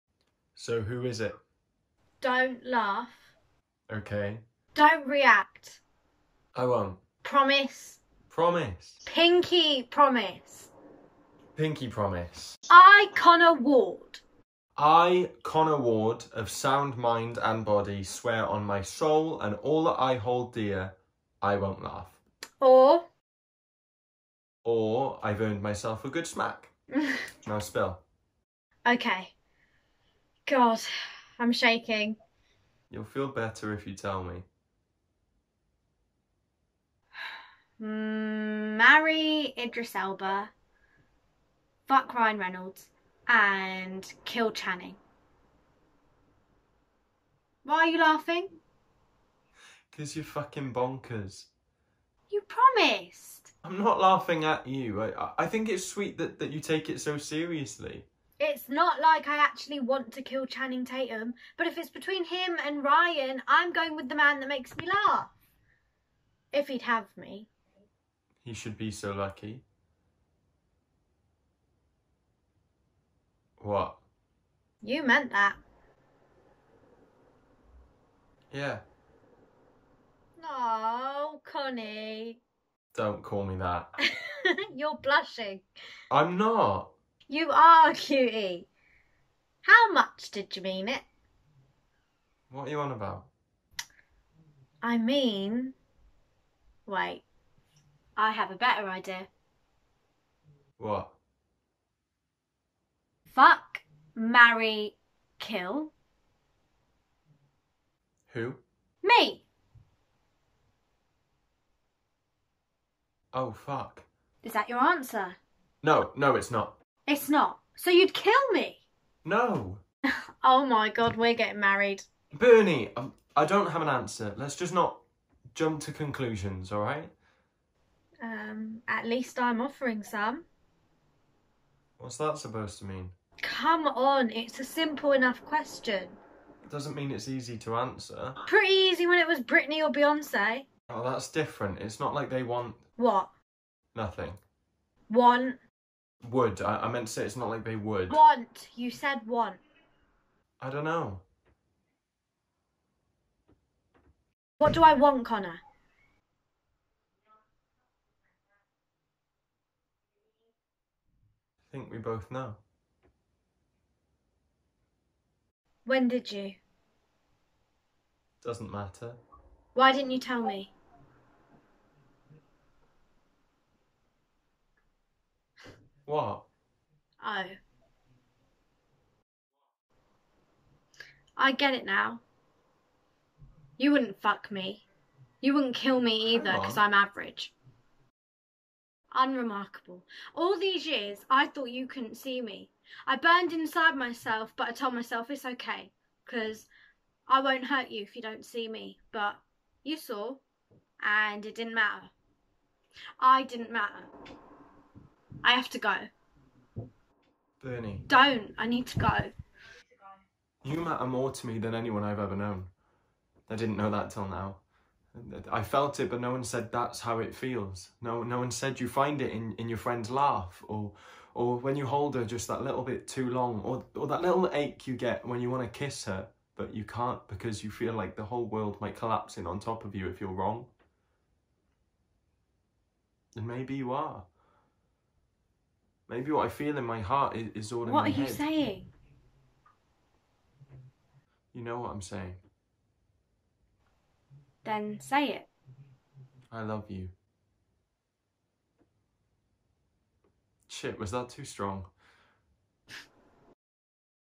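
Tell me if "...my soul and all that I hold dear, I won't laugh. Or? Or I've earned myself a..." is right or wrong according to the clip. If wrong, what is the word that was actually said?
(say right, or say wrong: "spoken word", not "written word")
right.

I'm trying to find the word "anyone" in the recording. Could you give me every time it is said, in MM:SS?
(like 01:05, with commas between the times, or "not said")
03:31.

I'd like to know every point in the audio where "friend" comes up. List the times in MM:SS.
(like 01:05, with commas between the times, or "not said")
03:39.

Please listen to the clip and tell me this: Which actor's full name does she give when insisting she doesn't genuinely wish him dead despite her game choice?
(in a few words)
Channing Tatum.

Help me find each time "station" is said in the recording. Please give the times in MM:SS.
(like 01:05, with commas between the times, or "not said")
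not said.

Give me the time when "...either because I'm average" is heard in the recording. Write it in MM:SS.
03:06.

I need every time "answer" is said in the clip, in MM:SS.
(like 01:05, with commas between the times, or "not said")
01:54, 02:03, 02:17.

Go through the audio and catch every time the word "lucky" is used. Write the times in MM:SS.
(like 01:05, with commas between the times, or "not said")
01:09.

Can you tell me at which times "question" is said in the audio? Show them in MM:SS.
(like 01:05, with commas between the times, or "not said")
02:15.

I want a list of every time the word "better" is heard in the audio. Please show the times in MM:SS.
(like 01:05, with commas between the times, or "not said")
00:33, 01:38.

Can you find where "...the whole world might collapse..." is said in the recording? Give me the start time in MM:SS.
03:48.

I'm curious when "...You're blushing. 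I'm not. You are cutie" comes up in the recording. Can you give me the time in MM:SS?
01:24.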